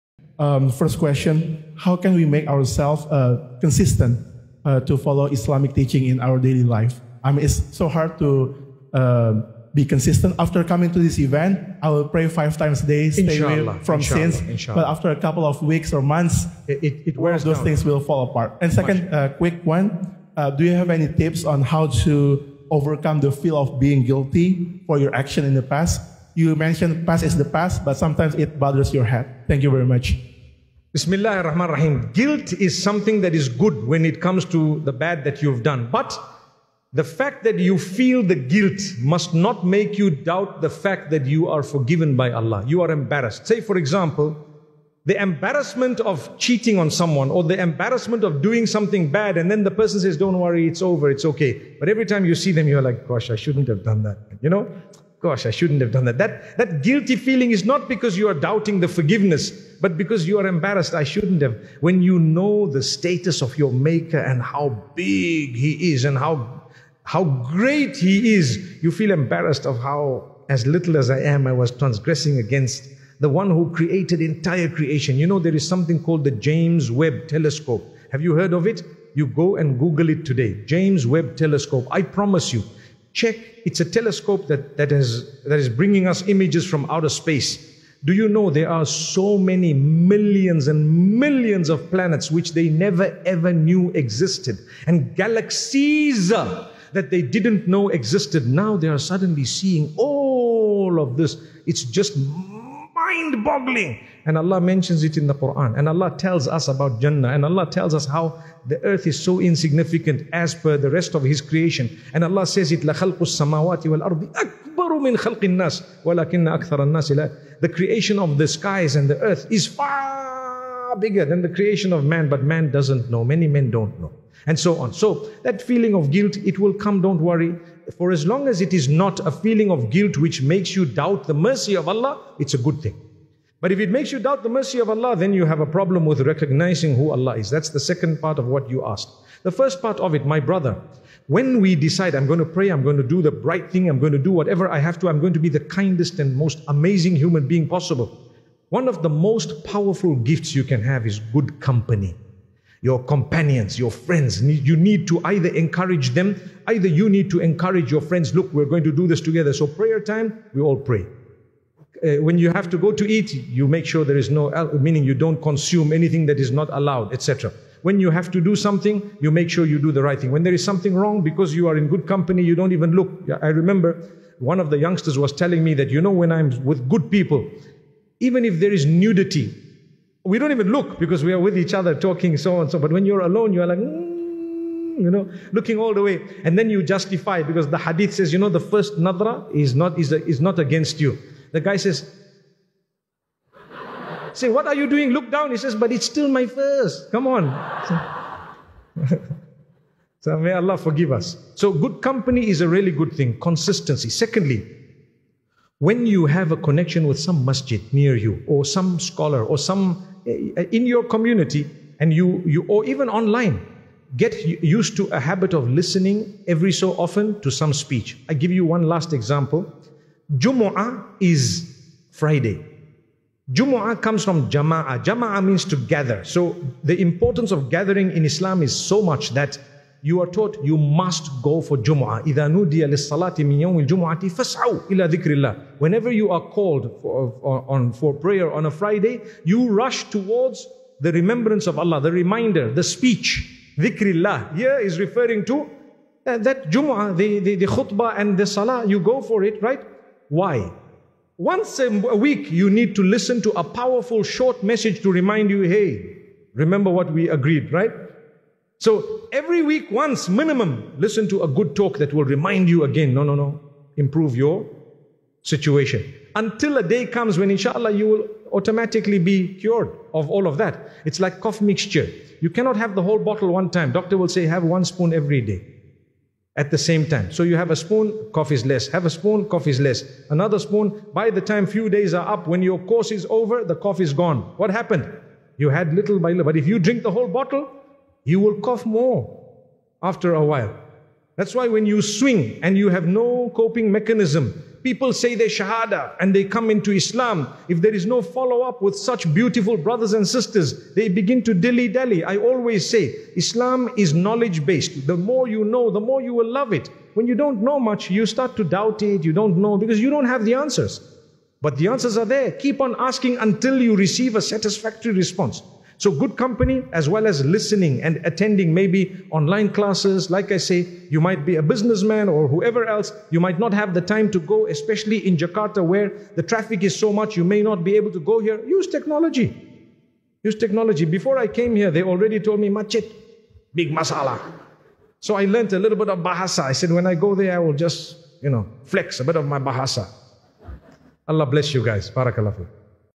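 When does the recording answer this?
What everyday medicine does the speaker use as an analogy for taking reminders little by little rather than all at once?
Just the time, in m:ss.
4:31.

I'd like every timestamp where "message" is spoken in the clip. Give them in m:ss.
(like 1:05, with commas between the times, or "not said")
4:14.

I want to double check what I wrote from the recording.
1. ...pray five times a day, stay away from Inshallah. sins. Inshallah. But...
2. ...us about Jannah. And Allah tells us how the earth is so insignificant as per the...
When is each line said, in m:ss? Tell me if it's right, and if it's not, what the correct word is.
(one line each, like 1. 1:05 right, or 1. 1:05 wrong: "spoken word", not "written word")
1. 0:12 right
2. 1:46 right.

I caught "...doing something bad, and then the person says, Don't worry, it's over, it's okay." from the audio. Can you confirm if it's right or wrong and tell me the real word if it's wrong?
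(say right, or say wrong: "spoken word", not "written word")
right.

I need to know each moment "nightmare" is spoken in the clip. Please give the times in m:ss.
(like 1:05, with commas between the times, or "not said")
not said.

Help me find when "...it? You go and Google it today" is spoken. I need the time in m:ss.
1:18.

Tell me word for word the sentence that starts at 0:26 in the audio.
You mentioned past is the past, but sometimes it bothers your head.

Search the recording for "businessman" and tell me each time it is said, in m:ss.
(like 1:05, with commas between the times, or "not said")
5:21.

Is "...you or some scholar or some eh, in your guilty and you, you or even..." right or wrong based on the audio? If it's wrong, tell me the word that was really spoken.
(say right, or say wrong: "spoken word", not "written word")
wrong: "community", not "guilty".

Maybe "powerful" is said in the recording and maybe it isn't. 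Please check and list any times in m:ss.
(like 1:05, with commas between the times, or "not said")
2:29, 4:13.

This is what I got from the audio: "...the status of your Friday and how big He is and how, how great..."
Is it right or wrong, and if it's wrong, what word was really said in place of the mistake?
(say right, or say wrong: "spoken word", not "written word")
wrong: "Maker", not "Friday".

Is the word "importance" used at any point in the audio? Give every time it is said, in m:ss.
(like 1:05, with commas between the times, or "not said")
3:47.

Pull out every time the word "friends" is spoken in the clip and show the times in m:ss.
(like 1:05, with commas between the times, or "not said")
2:33, 2:38.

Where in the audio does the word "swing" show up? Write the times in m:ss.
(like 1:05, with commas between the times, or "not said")
4:52.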